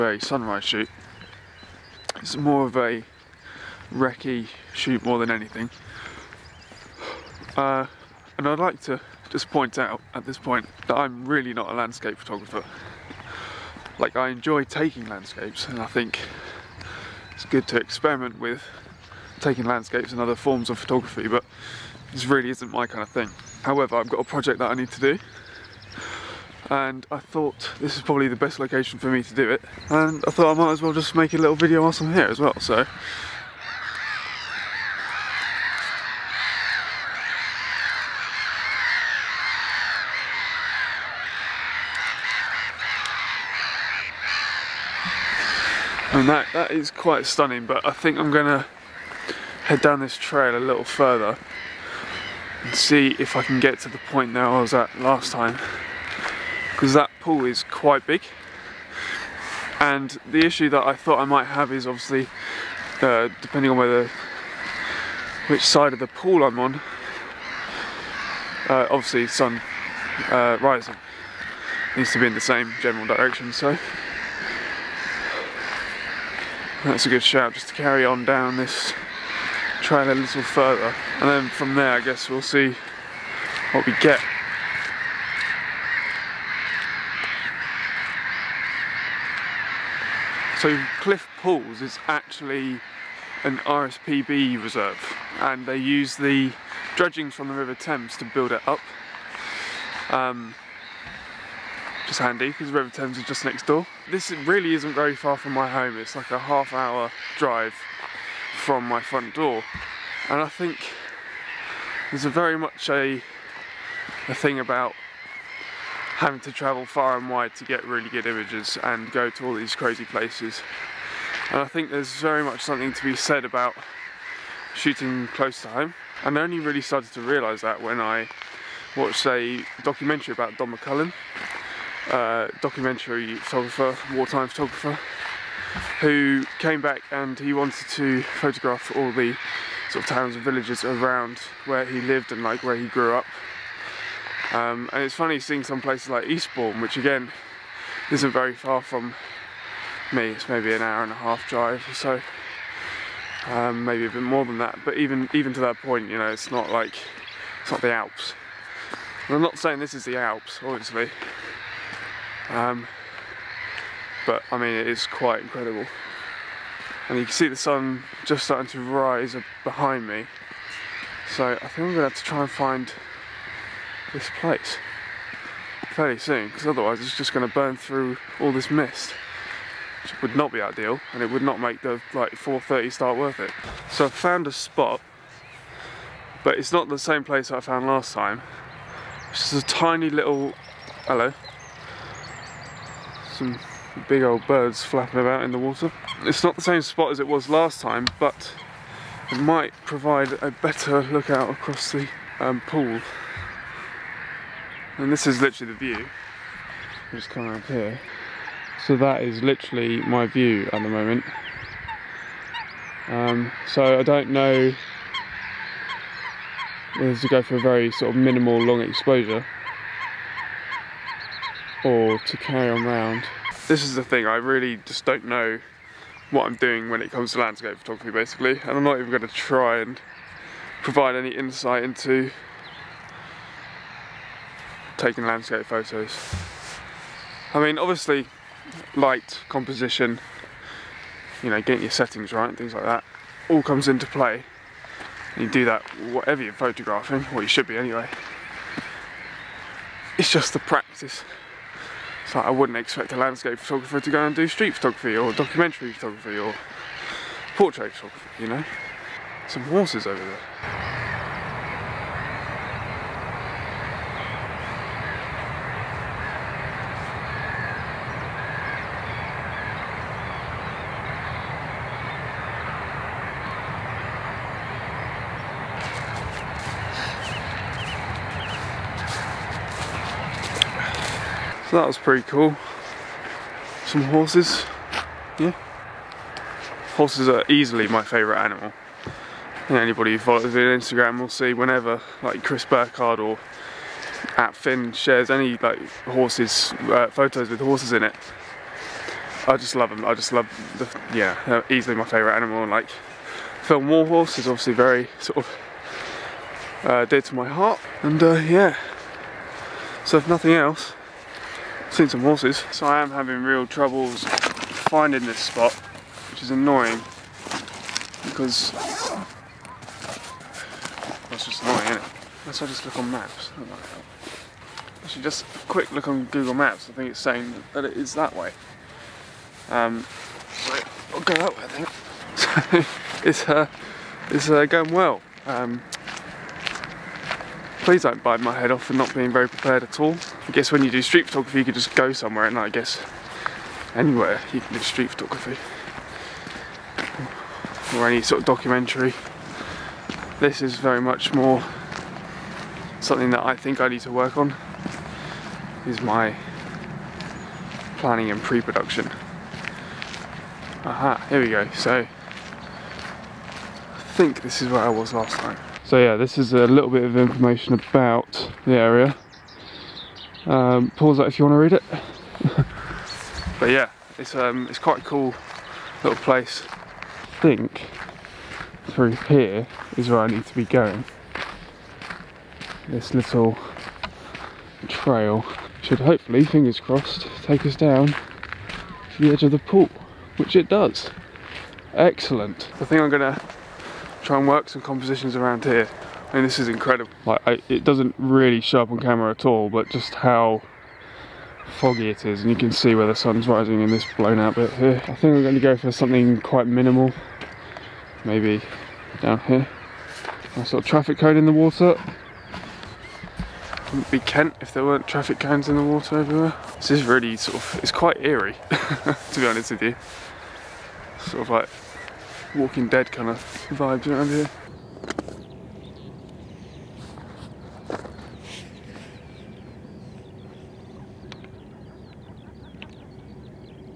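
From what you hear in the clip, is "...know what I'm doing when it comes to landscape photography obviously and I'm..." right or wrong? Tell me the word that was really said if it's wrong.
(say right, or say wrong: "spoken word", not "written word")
wrong: "basically", not "obviously".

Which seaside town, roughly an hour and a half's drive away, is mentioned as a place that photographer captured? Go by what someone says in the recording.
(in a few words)
Eastbourne.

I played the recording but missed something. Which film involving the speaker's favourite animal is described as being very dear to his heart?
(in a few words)
War Horse.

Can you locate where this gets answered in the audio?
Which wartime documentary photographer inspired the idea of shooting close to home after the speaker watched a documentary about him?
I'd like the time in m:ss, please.
2:10.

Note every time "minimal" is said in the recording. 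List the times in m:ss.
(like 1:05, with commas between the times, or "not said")
3:38, 6:46.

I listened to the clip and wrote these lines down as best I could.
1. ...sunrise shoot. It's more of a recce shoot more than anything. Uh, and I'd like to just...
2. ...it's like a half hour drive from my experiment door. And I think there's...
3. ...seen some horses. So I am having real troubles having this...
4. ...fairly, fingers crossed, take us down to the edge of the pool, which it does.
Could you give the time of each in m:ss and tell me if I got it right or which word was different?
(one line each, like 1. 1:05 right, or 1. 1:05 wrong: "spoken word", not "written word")
1. 0:00 right
2. 1:45 wrong: "front", not "experiment"
3. 5:11 wrong: "finding", not "having"
4. 6:25 wrong: "hopefully", not "fairly".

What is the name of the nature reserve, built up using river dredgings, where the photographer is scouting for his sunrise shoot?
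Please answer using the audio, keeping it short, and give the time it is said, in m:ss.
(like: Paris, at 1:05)
Cliffe Pools, at 1:30.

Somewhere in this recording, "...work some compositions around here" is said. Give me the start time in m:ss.
6:34.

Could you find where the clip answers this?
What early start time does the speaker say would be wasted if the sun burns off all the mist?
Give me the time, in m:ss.
3:02.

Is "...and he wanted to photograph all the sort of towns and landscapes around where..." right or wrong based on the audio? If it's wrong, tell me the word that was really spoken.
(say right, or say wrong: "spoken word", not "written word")
wrong: "villages", not "landscapes".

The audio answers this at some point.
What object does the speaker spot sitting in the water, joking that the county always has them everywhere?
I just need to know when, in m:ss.
6:50.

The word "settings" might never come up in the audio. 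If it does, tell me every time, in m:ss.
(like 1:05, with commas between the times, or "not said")
4:01.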